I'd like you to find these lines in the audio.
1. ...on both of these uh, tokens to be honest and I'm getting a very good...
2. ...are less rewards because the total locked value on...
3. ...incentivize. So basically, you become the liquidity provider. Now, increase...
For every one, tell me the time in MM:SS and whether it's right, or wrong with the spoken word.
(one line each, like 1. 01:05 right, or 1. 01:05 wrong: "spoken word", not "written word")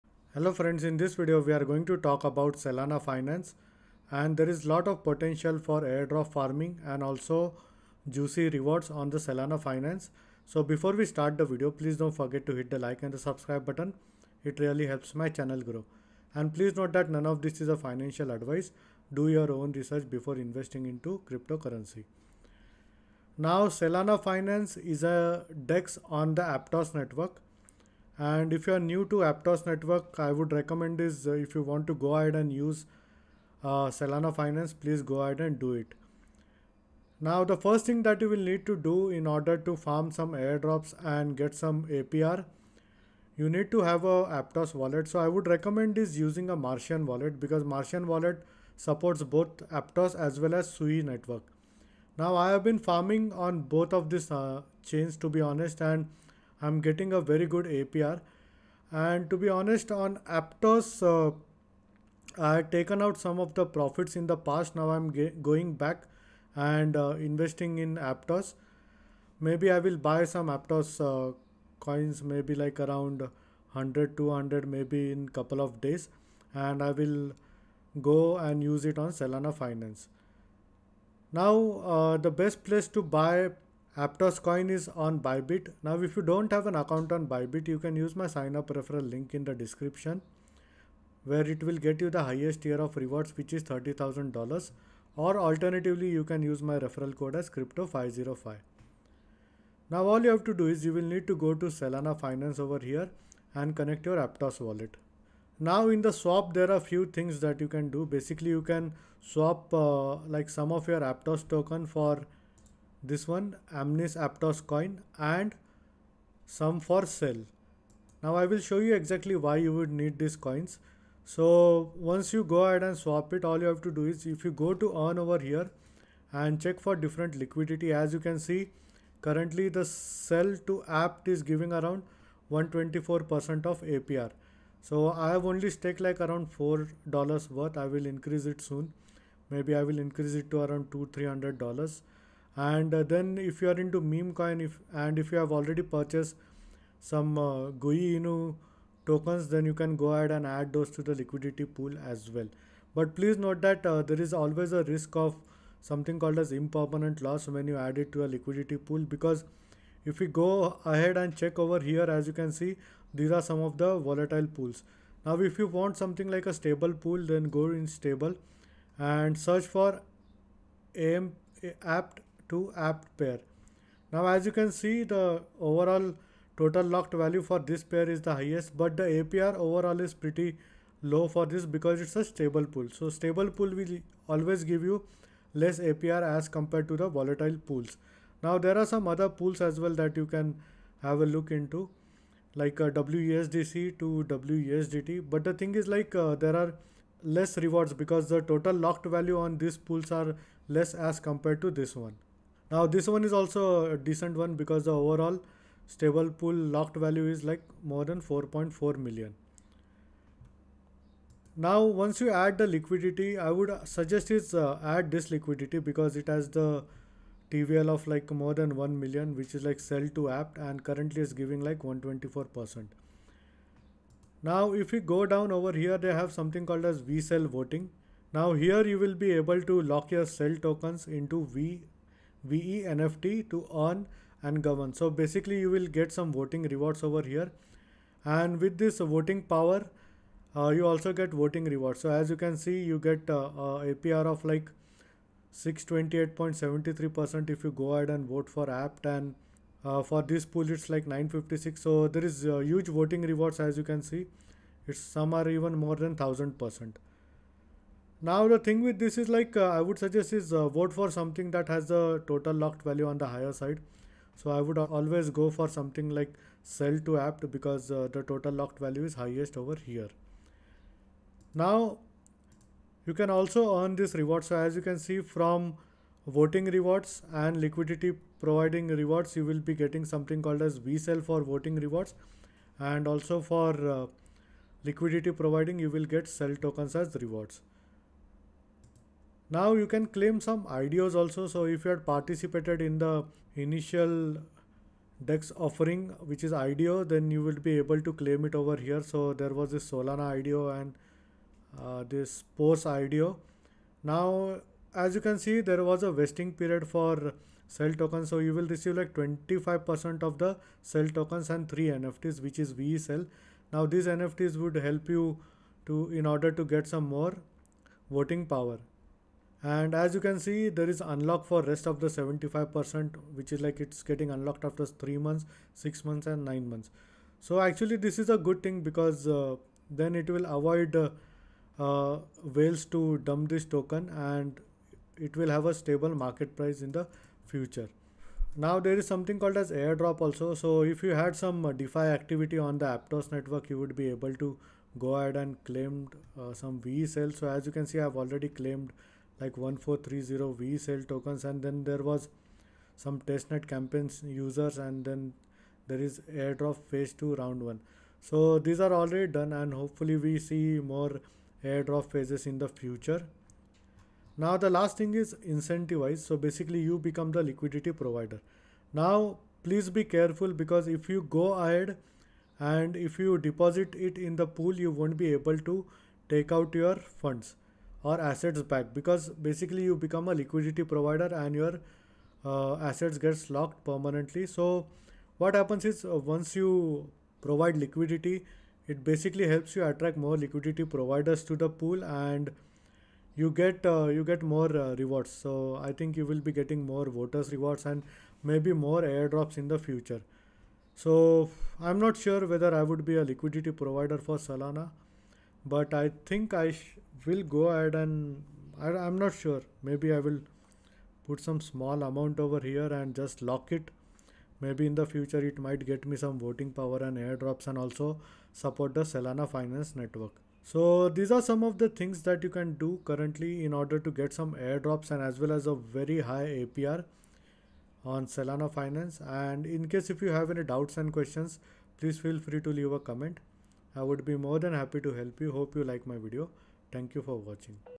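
1. 00:53 wrong: "chains", not "tokens"
2. 03:16 right
3. 06:05 wrong: "please", not "increase".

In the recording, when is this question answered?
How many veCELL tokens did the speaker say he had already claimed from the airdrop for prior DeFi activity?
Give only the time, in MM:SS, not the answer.
05:49.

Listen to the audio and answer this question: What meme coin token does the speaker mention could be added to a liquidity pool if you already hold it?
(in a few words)
GUI Inu.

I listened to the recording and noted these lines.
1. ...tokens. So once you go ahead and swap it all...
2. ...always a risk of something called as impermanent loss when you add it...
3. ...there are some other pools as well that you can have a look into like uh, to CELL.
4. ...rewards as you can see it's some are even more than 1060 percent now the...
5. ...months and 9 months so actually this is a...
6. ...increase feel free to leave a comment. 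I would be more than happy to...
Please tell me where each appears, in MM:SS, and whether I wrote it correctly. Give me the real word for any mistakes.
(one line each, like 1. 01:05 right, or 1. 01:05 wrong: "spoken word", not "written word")
1. 02:00 wrong: "coins", not "tokens"
2. 02:34 right
3. 03:08 wrong: "WESDT", not "CELL"
4. 04:13 wrong: "1000", not "1060"
5. 05:26 right
6. 07:11 wrong: "please", not "increase".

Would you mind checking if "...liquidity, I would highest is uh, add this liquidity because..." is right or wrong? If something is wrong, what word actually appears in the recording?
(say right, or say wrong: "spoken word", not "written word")
wrong: "suggest", not "highest".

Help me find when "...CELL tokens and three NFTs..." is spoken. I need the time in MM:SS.
05:10.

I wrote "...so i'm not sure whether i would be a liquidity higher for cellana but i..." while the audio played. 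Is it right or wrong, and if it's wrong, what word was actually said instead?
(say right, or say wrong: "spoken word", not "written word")
wrong: "provider", not "higher".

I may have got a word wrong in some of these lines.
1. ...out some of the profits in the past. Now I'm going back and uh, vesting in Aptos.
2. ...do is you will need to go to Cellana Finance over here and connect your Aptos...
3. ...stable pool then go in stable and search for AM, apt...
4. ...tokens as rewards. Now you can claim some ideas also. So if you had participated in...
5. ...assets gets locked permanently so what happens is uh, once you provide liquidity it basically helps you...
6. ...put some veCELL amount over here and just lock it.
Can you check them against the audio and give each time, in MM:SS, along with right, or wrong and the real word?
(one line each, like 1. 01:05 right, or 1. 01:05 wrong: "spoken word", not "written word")
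1. 01:03 wrong: "investing", not "vesting"
2. 01:40 right
3. 02:46 right
4. 04:46 right
5. 06:22 right
6. 06:51 wrong: "small", not "veCELL".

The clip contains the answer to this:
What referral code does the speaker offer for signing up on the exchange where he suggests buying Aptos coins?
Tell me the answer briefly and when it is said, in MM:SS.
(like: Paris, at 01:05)
crypto505, at 01:37.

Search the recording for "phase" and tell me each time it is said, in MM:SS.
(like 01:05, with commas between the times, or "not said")
05:56, 06:02.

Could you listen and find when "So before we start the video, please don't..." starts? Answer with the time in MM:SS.
00:10.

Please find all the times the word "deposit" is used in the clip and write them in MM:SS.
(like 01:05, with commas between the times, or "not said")
06:13.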